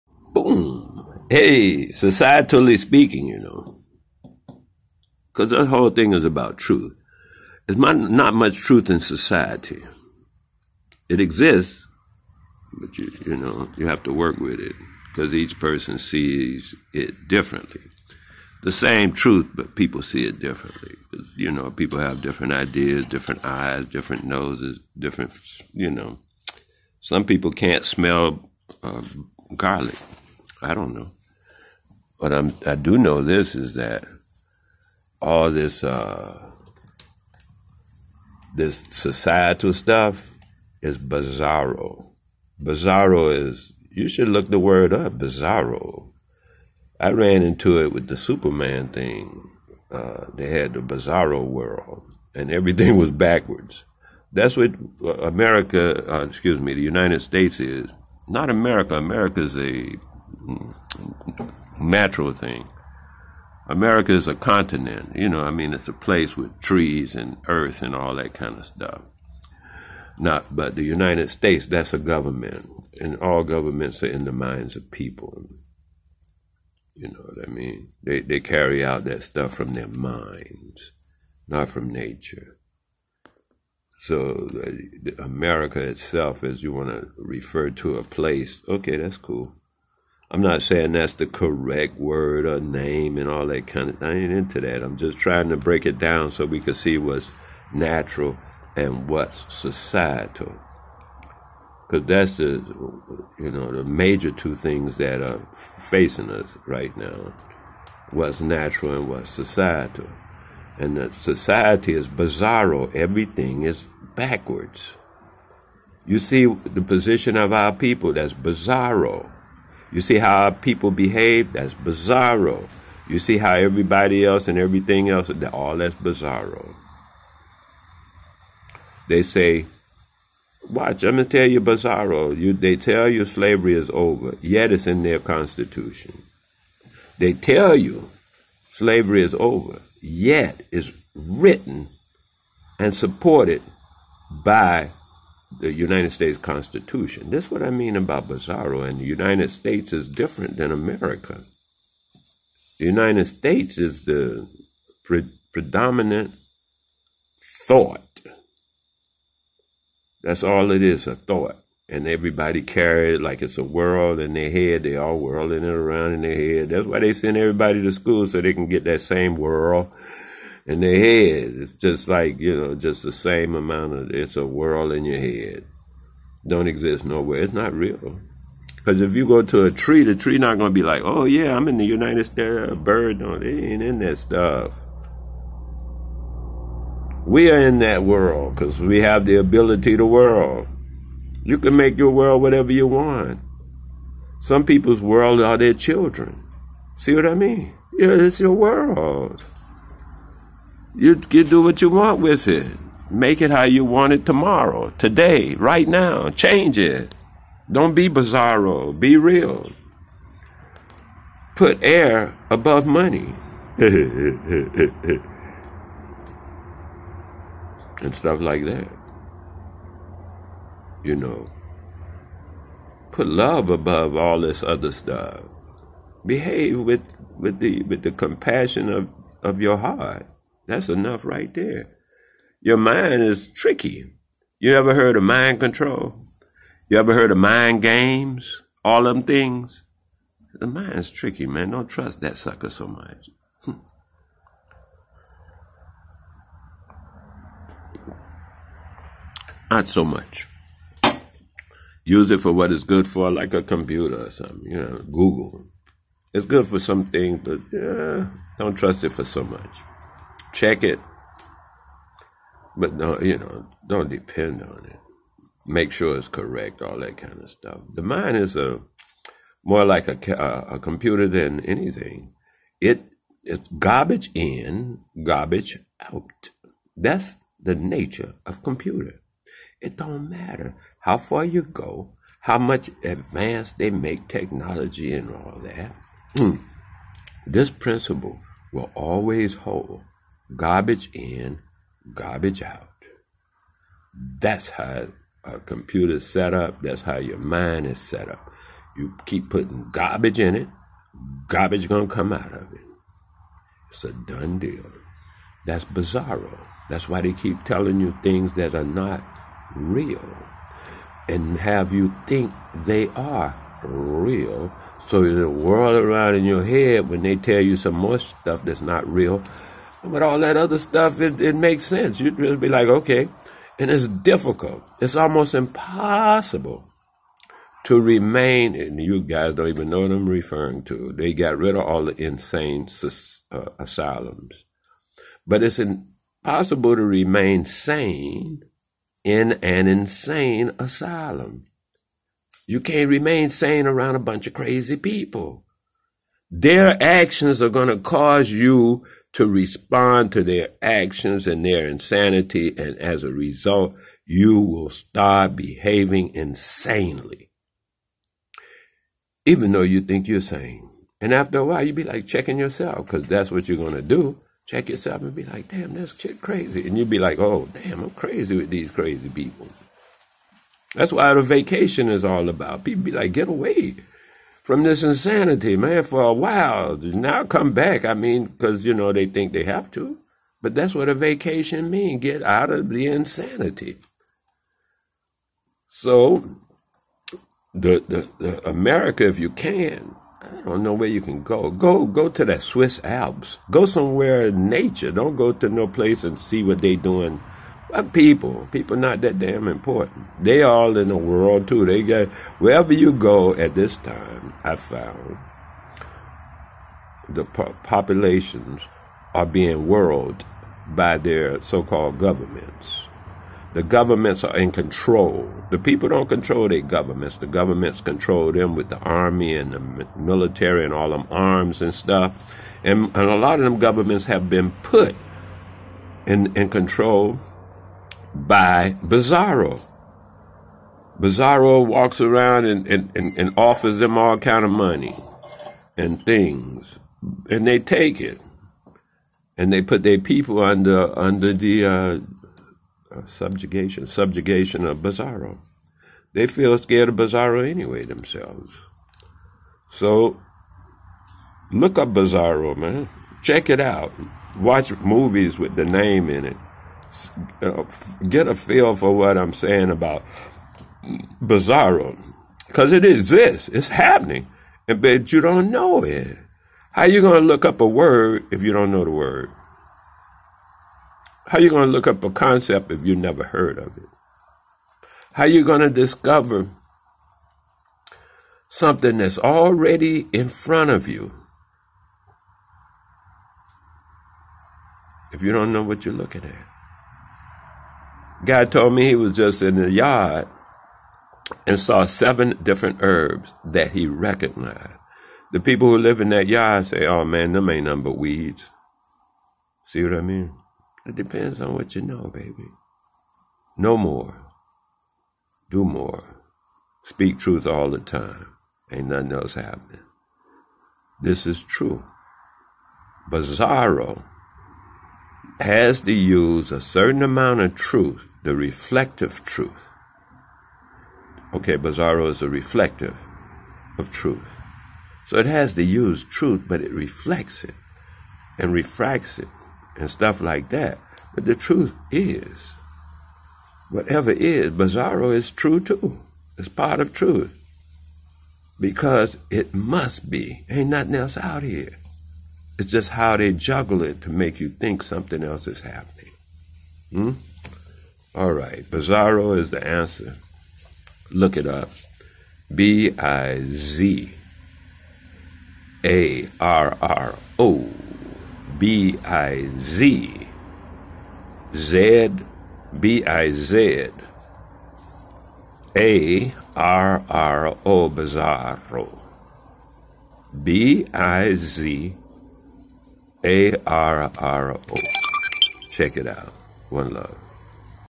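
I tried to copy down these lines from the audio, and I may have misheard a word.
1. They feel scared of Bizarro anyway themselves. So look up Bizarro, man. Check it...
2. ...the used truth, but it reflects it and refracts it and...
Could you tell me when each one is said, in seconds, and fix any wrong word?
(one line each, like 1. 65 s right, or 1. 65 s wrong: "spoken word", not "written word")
1. 446 s right
2. 525 s right.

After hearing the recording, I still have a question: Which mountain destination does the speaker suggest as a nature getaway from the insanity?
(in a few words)
the Swiss Alps.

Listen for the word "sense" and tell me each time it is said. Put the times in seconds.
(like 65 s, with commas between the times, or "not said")
321 s.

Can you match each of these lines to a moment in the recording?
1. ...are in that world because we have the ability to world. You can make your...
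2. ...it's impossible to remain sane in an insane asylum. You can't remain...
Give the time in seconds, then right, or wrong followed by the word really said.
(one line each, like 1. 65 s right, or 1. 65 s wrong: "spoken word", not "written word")
1. 187 s right
2. 335 s right.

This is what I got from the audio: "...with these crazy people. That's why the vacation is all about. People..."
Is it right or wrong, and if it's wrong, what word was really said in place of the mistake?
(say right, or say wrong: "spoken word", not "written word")
right.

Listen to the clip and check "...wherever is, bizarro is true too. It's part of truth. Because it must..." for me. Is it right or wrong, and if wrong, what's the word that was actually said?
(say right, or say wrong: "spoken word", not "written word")
wrong: "whatever", not "wherever".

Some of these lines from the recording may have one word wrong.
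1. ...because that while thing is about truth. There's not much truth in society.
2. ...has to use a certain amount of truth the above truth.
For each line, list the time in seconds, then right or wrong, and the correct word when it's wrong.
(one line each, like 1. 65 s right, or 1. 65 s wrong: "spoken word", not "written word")
1. 5 s wrong: "whole", not "while"
2. 515 s wrong: "reflective", not "above".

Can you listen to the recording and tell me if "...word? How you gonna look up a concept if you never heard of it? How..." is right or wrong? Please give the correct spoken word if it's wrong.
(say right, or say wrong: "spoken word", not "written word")
right.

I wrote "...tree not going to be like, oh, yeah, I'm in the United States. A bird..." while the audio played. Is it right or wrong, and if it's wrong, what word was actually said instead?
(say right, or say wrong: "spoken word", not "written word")
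right.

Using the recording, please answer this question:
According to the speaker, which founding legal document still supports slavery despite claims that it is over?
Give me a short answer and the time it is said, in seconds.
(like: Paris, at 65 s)
the United States Constitution, at 145 s.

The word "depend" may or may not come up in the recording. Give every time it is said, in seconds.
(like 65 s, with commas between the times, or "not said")
264 s, 501 s.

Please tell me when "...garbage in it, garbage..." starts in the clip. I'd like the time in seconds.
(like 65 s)
299 s.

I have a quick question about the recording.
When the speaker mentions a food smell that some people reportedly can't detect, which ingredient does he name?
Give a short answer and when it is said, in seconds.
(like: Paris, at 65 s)
garlic, at 29 s.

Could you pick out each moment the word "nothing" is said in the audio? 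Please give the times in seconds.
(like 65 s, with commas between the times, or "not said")
497 s, 509 s, 540 s.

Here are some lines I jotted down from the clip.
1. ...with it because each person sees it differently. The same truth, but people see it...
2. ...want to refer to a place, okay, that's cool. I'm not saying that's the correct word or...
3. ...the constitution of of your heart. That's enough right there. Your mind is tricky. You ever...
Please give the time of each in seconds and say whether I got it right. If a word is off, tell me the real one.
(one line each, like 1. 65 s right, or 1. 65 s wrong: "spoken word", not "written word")
1. 14 s right
2. 86 s right
3. 228 s wrong: "compassion", not "constitution".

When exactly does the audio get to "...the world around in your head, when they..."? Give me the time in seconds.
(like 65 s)
315 s.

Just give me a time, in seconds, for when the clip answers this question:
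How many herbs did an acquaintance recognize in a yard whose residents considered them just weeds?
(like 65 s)
492 s.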